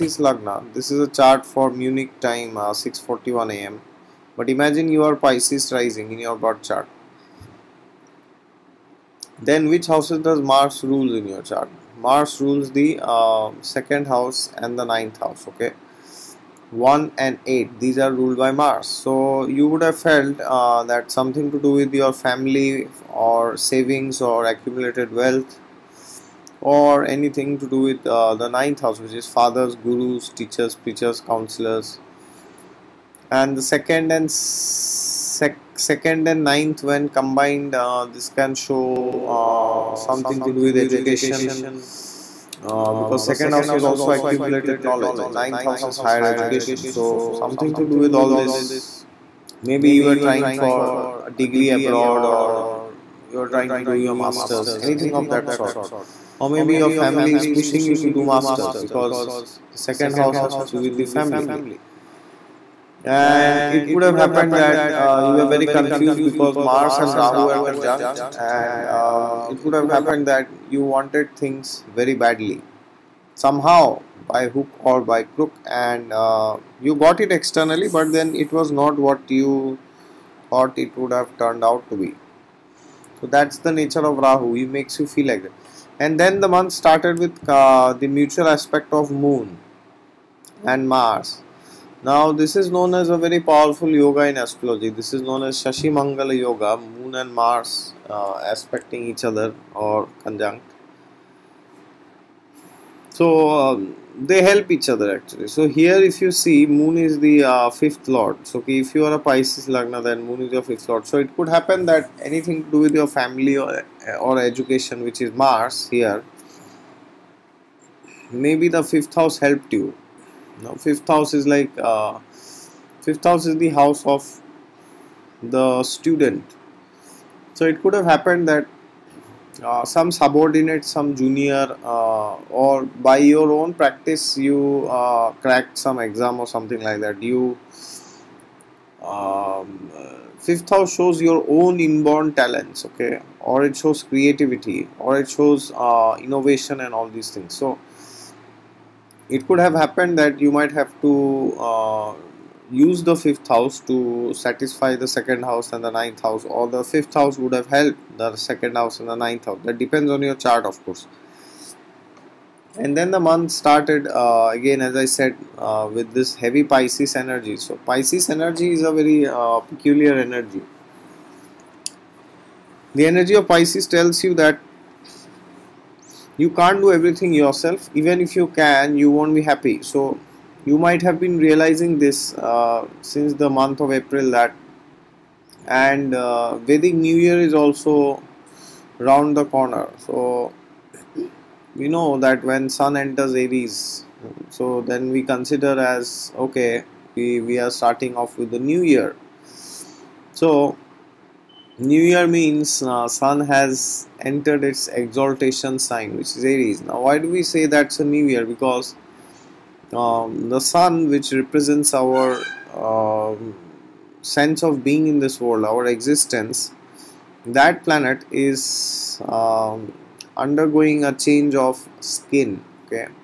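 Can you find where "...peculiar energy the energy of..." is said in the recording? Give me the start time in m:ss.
2:49.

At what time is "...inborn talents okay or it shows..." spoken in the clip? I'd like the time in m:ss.
2:21.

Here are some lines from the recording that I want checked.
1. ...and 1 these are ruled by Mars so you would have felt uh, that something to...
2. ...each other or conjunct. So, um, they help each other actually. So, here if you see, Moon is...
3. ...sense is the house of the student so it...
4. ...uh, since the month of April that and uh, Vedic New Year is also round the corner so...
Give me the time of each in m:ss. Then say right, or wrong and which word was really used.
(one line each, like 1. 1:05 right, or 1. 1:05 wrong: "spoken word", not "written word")
1. 0:17 wrong: "8", not "1"
2. 1:39 right
3. 2:03 wrong: "house", not "sense"
4. 3:02 right.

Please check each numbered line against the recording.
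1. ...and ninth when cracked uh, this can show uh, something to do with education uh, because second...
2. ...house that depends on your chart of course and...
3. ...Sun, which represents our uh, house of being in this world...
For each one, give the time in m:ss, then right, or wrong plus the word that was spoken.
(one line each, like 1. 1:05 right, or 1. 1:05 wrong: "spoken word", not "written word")
1. 0:36 wrong: "combined", not "cracked"
2. 2:39 right
3. 3:30 wrong: "sense", not "house".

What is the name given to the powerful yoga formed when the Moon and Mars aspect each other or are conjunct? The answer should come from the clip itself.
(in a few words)
Shashi Mangala Yoga.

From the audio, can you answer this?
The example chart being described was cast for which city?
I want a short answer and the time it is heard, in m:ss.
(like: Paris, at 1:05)
Munich, at 0:01.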